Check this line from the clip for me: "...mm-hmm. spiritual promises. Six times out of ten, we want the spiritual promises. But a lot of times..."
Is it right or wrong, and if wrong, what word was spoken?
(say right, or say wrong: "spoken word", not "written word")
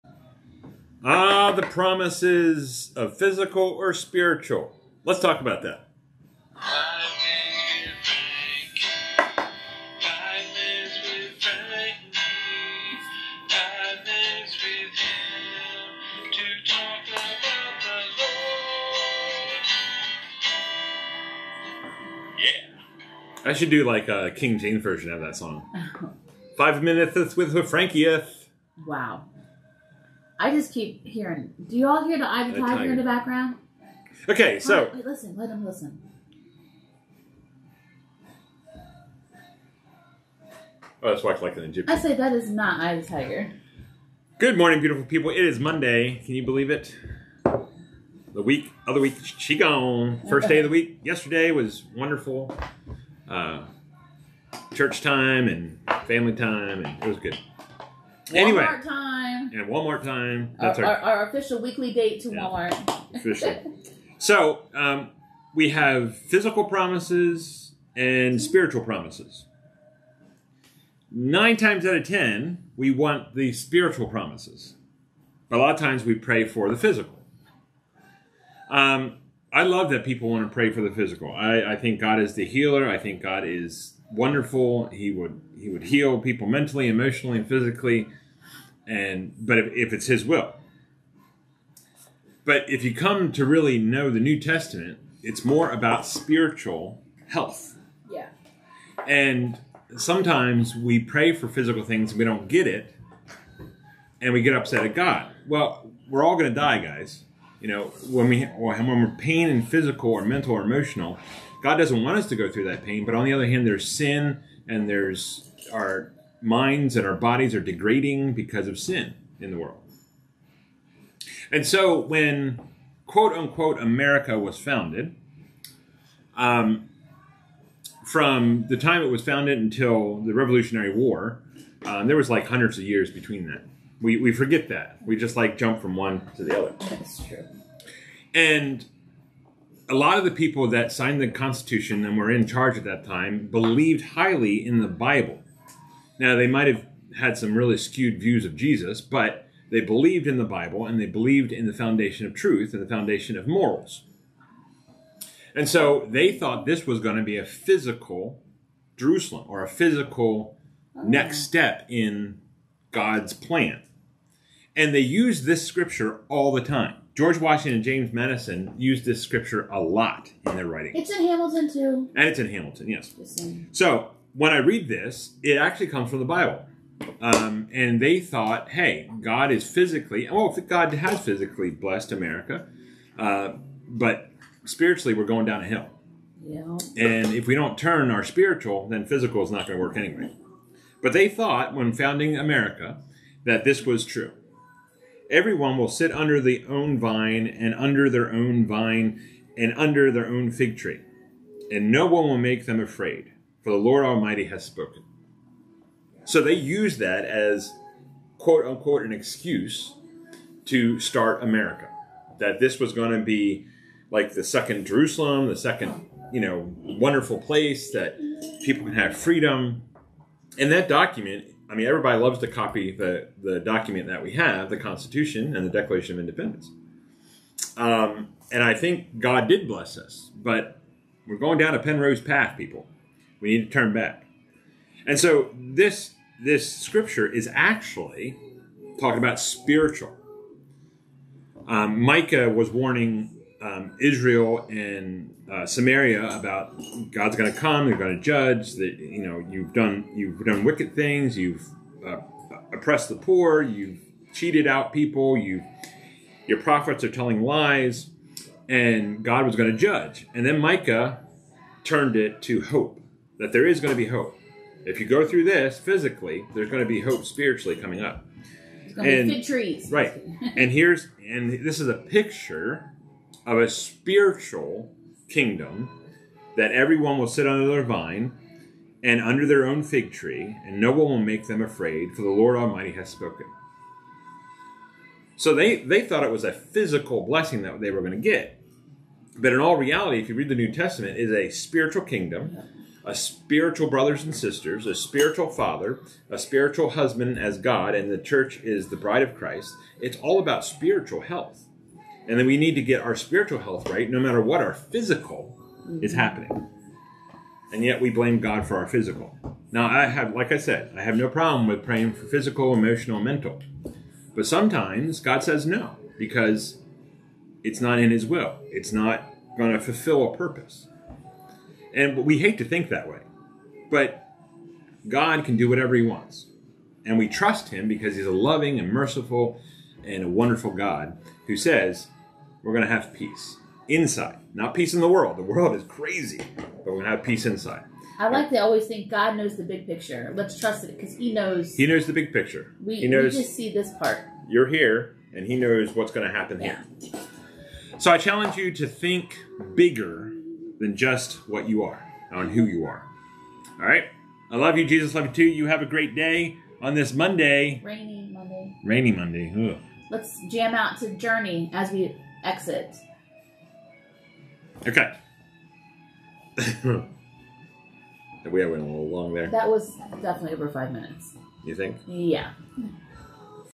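wrong: "Nine", not "Six".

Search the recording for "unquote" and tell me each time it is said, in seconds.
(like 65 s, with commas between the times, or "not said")
123 s, 208 s.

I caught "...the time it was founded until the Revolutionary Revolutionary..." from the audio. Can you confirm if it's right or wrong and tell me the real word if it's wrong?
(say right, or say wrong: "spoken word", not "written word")
wrong: "War", not "Revolutionary".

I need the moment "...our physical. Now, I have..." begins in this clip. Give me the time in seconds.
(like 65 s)
308 s.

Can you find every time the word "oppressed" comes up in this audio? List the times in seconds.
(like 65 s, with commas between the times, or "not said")
252 s.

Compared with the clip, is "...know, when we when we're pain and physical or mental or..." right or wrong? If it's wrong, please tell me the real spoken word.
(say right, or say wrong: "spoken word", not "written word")
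right.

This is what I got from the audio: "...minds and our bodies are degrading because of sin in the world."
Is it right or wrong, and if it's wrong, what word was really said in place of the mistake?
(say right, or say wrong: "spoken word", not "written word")
right.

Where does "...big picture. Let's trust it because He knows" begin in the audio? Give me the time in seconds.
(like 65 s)
339 s.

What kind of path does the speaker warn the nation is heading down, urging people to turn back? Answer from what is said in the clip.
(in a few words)
Penrose path.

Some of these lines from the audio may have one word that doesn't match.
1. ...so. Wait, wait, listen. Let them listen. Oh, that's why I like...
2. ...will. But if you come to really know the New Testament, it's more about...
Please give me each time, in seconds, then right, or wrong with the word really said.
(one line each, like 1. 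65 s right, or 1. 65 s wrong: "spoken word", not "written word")
1. 34 s right
2. 90 s right.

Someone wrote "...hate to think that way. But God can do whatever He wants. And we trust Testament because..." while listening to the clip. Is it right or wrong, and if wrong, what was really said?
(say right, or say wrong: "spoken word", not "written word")
wrong: "Him", not "Testament".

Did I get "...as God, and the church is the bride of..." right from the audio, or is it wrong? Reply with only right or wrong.
right.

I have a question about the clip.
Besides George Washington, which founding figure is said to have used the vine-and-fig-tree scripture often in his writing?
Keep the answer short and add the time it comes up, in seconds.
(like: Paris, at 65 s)
James Madison, at 167 s.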